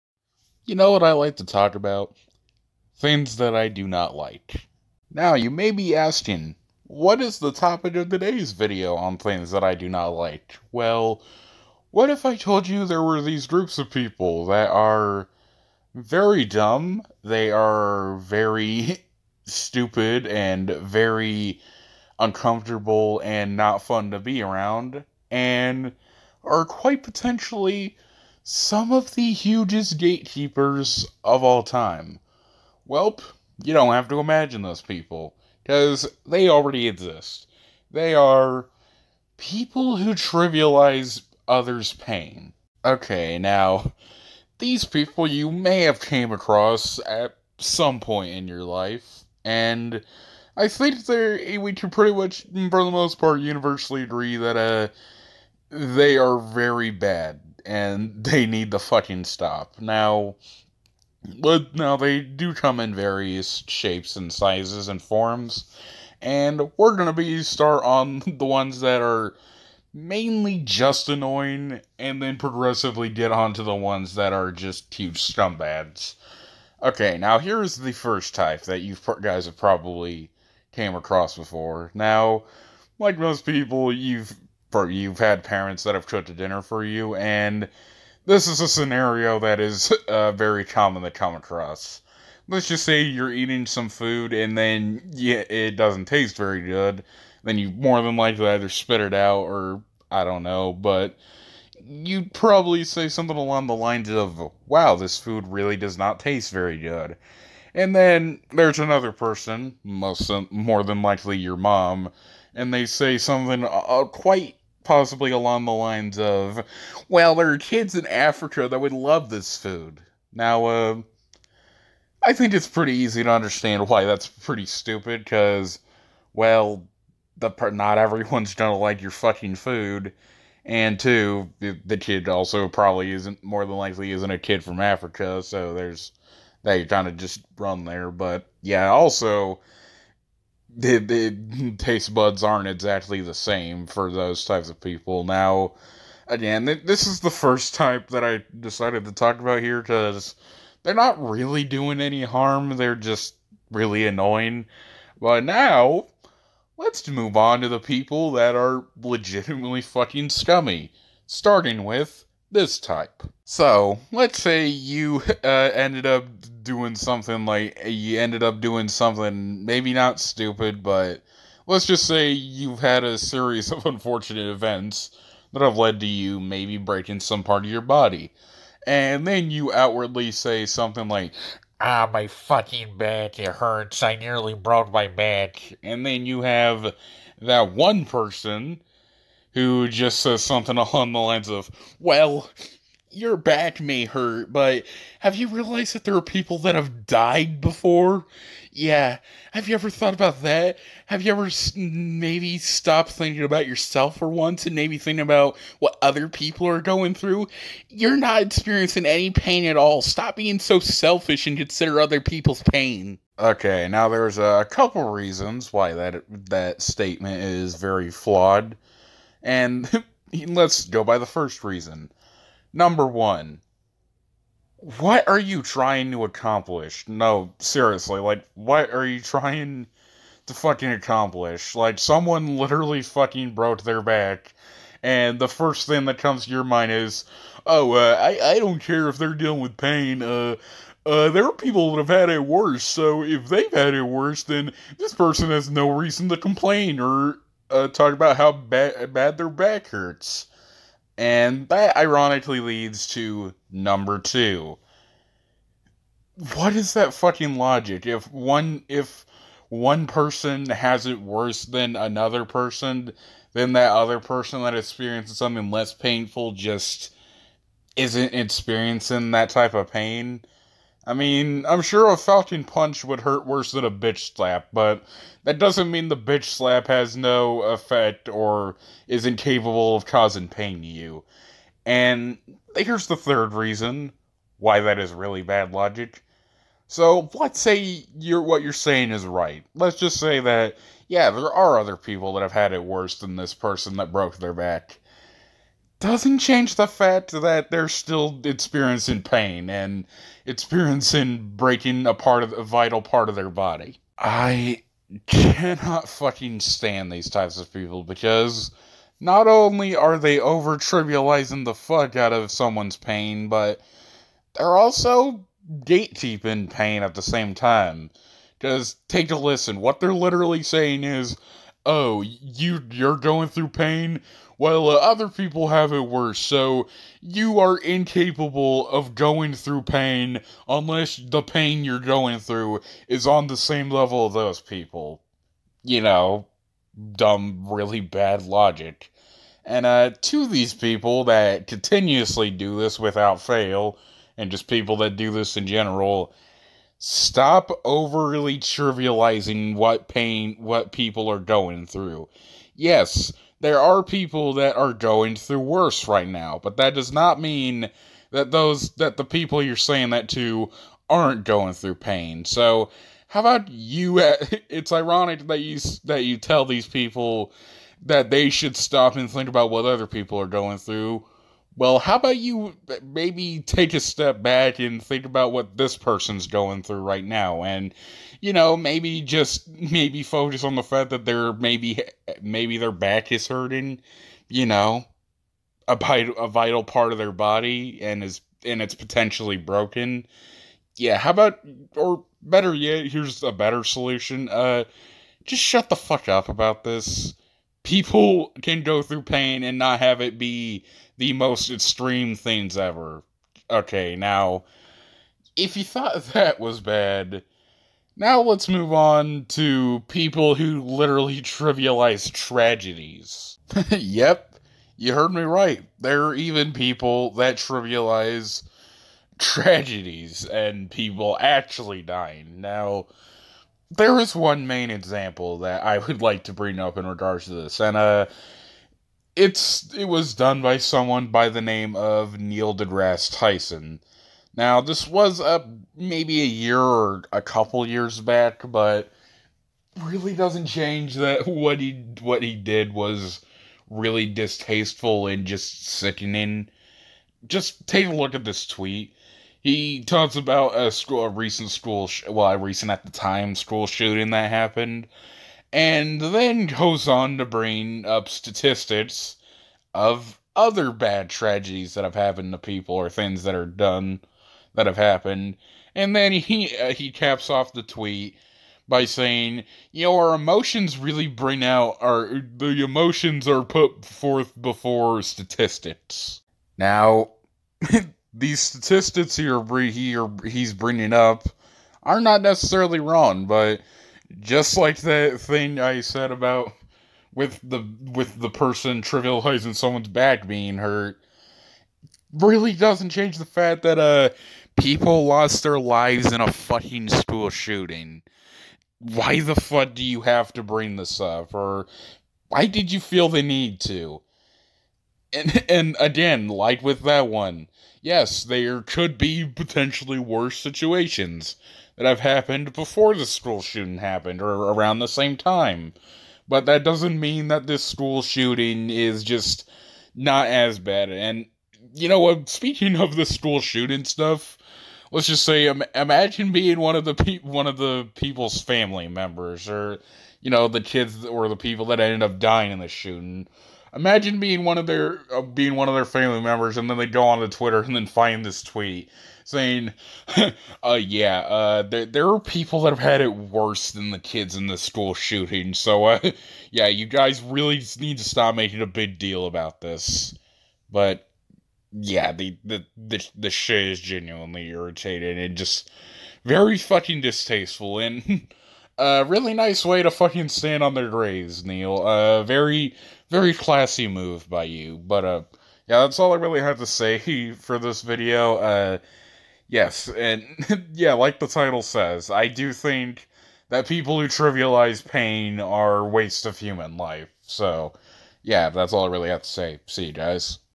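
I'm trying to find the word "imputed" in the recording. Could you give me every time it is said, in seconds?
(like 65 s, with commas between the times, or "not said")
not said.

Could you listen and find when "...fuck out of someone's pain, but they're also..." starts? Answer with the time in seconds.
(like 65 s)
311 s.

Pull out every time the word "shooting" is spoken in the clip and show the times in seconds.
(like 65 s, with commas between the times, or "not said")
453 s, 497 s, 513 s, 518 s, 523 s, 532 s, 545 s.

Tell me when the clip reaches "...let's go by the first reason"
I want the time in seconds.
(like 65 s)
220 s.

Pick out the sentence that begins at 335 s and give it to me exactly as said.
You know, dumb, really bad logic.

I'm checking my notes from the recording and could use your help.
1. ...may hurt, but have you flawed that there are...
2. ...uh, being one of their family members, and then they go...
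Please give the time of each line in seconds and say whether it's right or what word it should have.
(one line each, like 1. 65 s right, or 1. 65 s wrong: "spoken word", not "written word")
1. 193 s wrong: "realized", not "flawed"
2. 535 s right.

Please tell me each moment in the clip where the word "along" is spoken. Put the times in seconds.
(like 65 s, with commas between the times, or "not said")
103 s, 115 s, 190 s.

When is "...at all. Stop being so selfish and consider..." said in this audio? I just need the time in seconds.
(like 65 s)
209 s.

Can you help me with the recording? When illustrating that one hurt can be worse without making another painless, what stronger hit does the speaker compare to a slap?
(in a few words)
falcon punch.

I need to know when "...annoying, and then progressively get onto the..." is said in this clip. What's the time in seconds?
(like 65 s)
71 s.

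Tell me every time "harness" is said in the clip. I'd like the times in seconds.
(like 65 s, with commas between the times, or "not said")
not said.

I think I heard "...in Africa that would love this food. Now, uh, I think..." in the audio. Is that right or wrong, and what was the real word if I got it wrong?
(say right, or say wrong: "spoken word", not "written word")
right.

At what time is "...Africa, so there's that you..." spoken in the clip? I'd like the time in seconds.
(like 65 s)
134 s.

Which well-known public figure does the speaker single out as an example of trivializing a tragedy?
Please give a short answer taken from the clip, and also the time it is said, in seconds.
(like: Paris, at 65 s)
Neil deGrasse Tyson, at 432 s.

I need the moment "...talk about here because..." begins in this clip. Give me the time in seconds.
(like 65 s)
149 s.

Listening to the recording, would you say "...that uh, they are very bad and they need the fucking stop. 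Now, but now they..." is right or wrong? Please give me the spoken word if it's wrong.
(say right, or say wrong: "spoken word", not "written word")
right.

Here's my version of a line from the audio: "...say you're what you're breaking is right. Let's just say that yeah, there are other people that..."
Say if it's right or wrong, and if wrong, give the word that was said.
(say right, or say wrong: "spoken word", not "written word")
wrong: "saying", not "breaking".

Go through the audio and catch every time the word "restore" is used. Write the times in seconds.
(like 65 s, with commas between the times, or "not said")
not said.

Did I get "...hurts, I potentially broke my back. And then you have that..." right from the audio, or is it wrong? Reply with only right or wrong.
wrong.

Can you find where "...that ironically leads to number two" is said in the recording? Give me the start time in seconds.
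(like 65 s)
251 s.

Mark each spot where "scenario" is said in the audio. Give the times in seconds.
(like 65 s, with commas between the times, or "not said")
88 s.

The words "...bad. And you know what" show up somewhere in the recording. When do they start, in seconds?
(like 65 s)
520 s.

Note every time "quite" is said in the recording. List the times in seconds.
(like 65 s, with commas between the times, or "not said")
26 s, 114 s.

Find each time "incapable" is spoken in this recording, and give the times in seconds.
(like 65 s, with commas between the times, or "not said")
279 s, 327 s.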